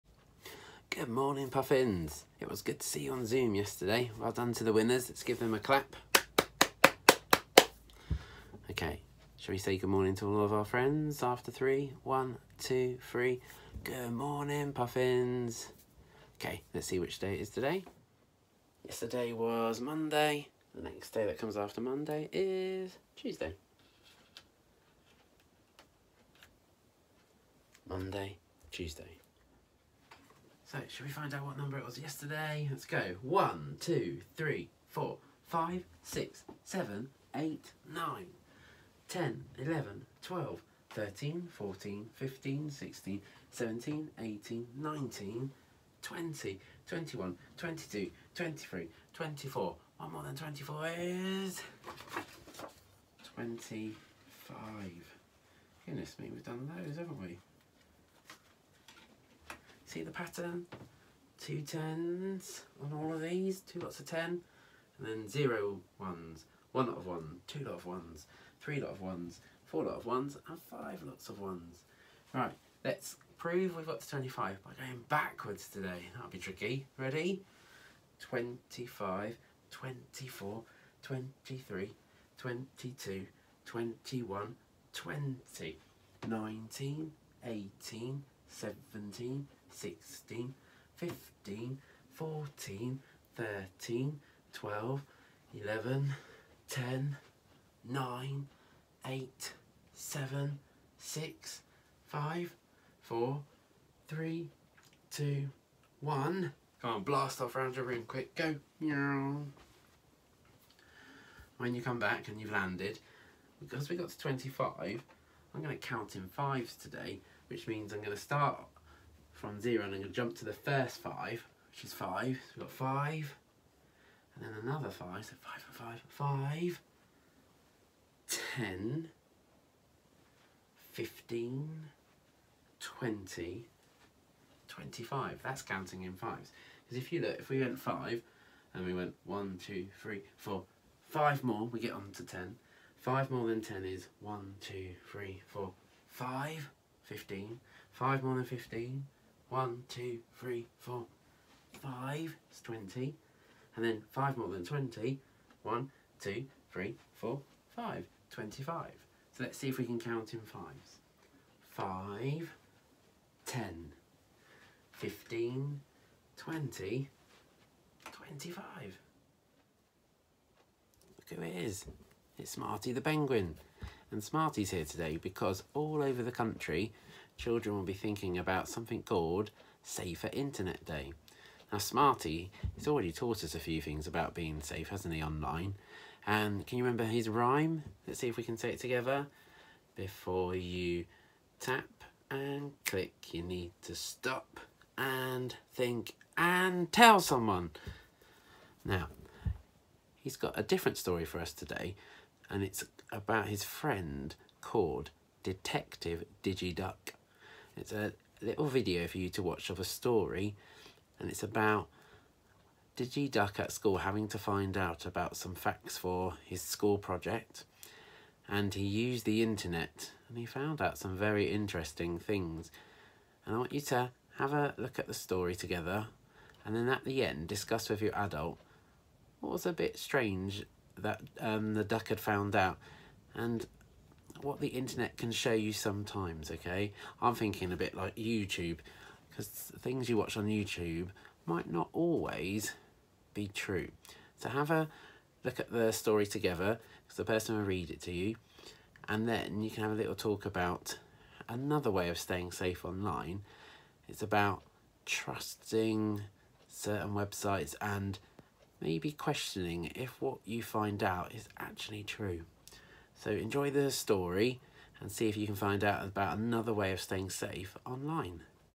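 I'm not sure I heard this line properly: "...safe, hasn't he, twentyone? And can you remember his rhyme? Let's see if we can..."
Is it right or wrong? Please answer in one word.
wrong.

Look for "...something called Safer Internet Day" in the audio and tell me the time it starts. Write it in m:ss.
2:58.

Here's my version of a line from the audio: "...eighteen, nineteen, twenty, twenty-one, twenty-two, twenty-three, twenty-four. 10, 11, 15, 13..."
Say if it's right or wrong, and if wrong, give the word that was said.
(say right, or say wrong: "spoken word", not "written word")
wrong: "12", not "15".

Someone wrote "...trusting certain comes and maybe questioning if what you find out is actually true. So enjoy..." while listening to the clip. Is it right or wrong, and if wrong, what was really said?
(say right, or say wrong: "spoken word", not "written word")
wrong: "websites", not "comes".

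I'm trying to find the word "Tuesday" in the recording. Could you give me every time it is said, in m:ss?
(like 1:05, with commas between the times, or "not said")
0:23, 0:28.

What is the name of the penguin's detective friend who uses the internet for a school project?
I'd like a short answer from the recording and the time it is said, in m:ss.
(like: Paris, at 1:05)
Detective Digiduck, at 3:25.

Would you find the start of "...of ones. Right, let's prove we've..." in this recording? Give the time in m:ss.
1:11.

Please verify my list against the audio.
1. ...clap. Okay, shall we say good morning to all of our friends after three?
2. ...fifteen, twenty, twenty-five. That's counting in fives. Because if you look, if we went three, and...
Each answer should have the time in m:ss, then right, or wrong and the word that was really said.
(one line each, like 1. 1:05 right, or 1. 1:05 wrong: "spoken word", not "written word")
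1. 0:05 right
2. 2:10 wrong: "five", not "three".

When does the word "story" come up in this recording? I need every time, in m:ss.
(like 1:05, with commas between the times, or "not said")
3:20, 3:29, 3:45, 4:05, 4:23.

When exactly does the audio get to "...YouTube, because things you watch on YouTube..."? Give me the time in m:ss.
3:58.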